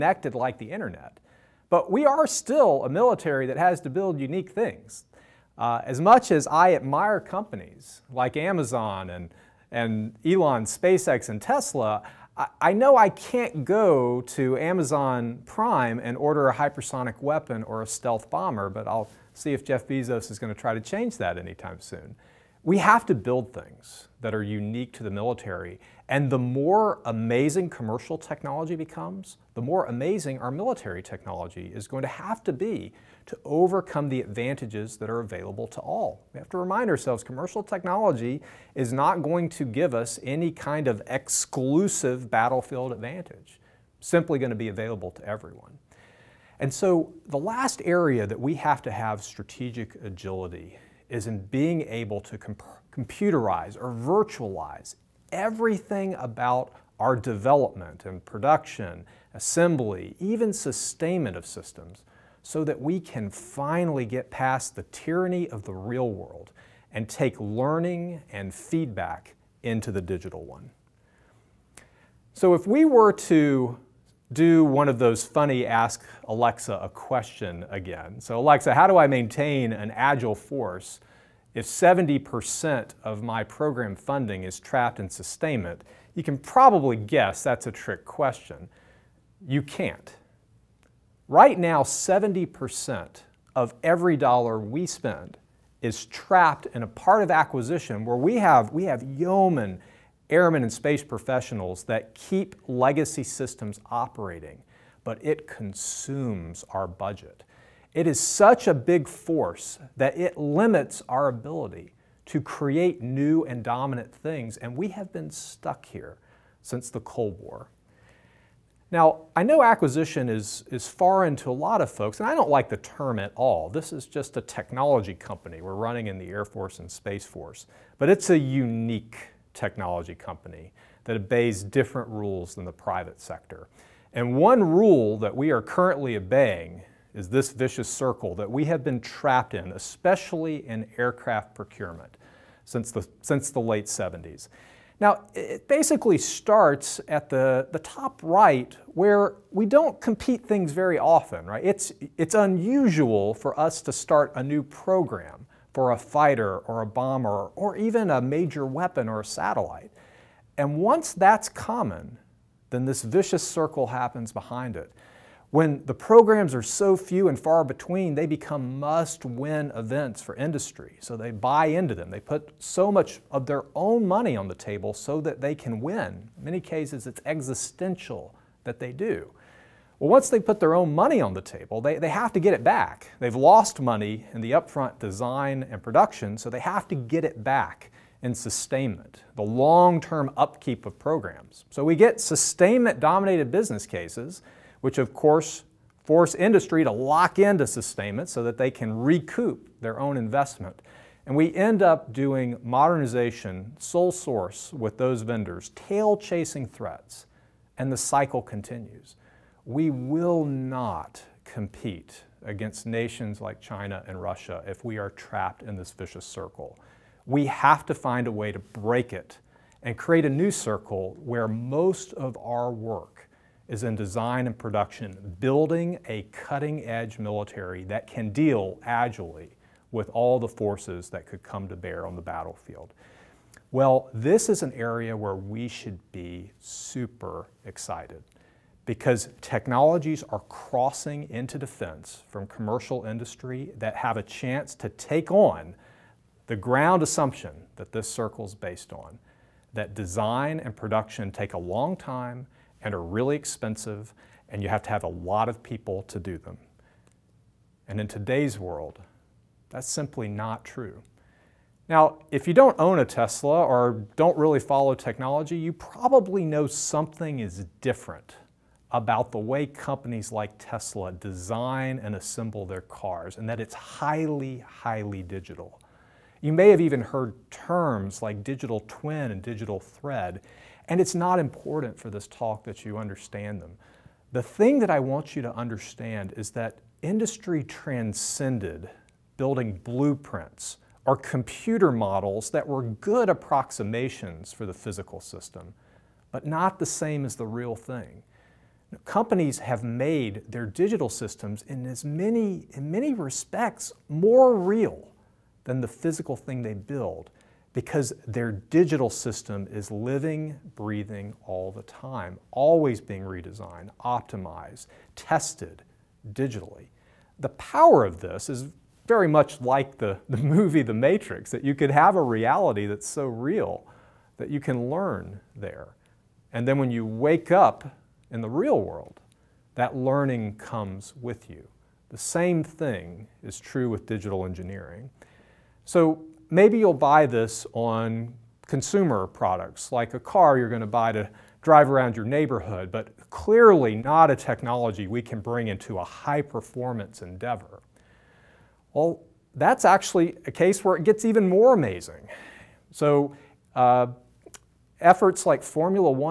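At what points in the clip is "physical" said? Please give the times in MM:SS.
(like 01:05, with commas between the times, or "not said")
04:54, 05:05.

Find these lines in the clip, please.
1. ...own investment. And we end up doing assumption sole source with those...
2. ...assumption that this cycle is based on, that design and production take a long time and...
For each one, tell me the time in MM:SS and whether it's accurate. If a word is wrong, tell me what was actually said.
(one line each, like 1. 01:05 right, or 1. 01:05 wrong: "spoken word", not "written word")
1. 03:19 wrong: "modernization", not "assumption"
2. 04:07 wrong: "circle", not "cycle".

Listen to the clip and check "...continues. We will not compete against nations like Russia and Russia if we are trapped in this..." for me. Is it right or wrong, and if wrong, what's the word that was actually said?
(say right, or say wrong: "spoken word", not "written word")
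wrong: "China", not "Russia".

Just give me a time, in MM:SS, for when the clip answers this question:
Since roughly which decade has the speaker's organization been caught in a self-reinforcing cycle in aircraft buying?
02:23.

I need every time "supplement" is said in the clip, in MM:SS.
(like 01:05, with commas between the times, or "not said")
not said.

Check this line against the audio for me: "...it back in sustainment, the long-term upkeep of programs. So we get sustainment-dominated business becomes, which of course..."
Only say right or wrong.
wrong.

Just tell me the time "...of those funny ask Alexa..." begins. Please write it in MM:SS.
01:14.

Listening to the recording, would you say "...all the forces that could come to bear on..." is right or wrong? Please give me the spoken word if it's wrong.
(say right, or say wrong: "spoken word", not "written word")
right.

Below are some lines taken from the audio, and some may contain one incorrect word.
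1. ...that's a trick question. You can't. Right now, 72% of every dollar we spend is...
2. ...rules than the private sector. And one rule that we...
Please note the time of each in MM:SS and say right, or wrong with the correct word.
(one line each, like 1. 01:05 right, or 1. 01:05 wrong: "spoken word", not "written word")
1. 01:27 wrong: "70", not "72"
2. 02:12 right.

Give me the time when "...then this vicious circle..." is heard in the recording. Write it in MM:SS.
02:42.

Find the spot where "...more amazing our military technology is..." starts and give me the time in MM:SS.
00:29.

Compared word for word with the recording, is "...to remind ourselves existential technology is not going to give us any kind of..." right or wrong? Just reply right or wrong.
wrong.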